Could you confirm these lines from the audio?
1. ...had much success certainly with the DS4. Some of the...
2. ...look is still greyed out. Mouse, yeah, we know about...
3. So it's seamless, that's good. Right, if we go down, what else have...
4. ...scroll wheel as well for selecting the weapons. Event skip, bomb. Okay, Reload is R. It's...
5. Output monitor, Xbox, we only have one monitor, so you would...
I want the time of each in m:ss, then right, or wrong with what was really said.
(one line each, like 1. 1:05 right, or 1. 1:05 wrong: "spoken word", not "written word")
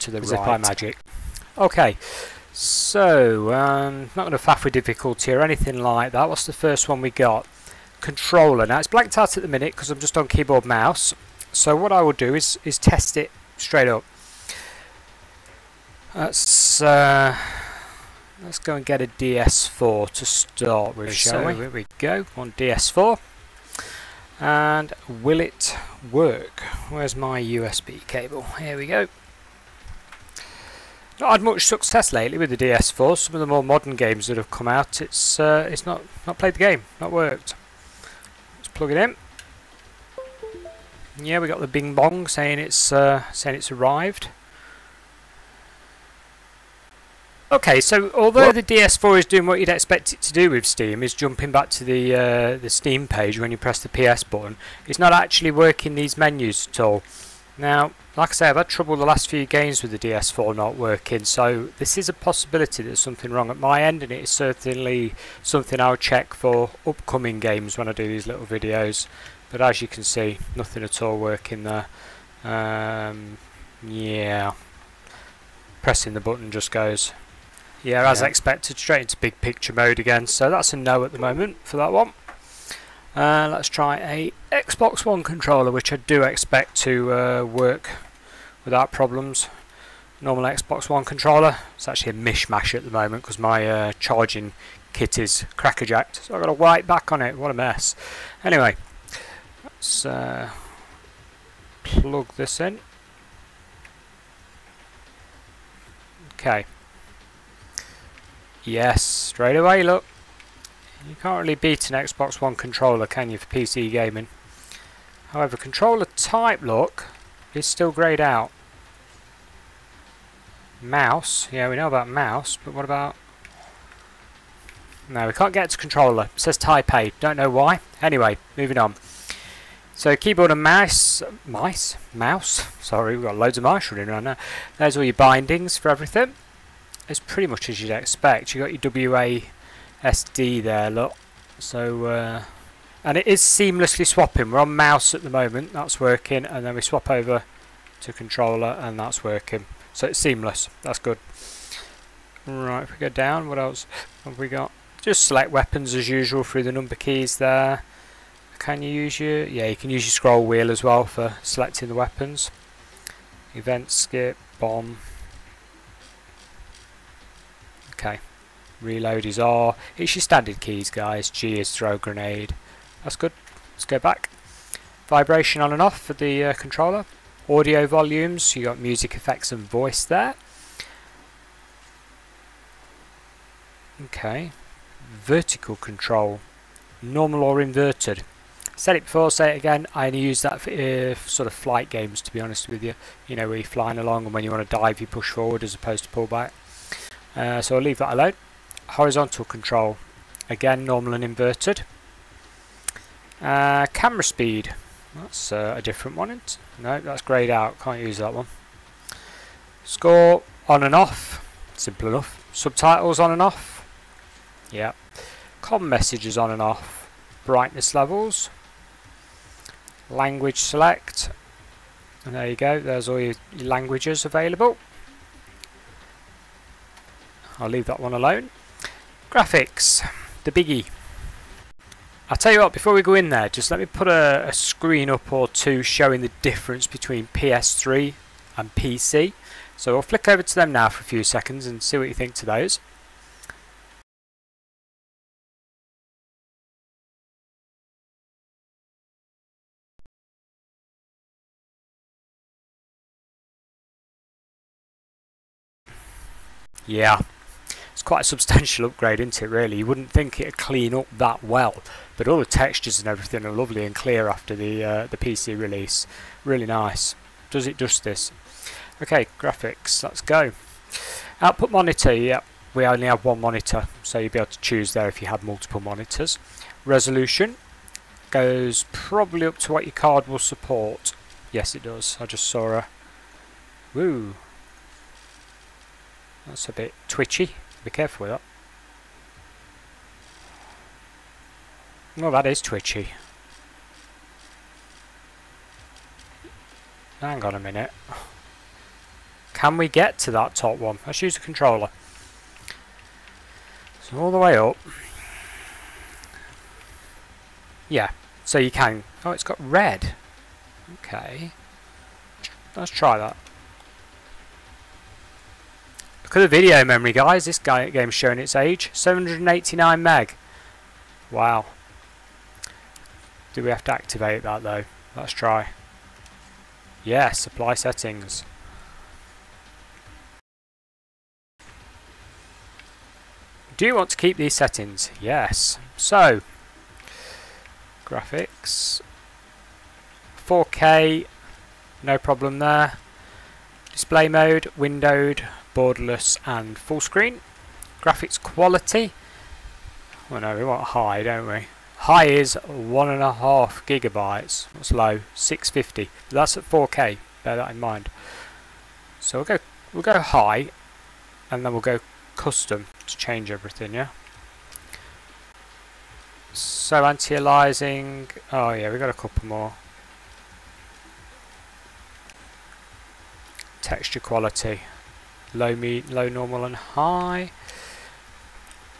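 1. 0:31 wrong: "lately", not "certainly"
2. 1:56 right
3. 2:29 right
4. 2:40 right
5. 4:31 wrong: "Yep", not "Xbox".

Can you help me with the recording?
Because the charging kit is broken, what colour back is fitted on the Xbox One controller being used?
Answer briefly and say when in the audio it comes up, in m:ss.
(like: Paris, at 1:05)
White, at 1:36.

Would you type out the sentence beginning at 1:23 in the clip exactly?
Uh, let's try a Xbox One controller, which I do expect to uh, work without problems.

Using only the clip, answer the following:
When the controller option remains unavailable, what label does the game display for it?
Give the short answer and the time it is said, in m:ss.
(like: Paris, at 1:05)
Type B, at 2:06.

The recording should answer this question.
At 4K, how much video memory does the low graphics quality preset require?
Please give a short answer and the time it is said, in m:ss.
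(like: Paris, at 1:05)
650, at 5:55.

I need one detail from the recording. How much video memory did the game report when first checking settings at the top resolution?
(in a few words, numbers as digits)
789 meg.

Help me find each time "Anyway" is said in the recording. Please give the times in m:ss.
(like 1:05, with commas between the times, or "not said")
1:38, 2:08.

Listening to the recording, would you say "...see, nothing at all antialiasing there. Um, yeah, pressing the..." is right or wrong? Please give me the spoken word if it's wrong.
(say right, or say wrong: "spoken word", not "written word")
wrong: "working", not "antialiasing".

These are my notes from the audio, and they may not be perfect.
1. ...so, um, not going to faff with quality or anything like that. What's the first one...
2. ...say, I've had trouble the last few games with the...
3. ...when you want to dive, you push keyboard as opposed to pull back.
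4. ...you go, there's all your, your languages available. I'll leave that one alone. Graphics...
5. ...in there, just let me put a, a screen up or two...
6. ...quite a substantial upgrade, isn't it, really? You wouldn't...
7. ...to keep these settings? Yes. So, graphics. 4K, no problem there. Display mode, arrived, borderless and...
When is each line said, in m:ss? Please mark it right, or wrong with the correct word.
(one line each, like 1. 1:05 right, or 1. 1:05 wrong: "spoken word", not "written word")
1. 0:02 wrong: "difficulty", not "quality"
2. 0:58 right
3. 3:14 wrong: "forward", not "keyboard"
4. 3:42 right
5. 3:53 right
6. 4:18 right
7. 5:34 wrong: "windowed", not "arrived".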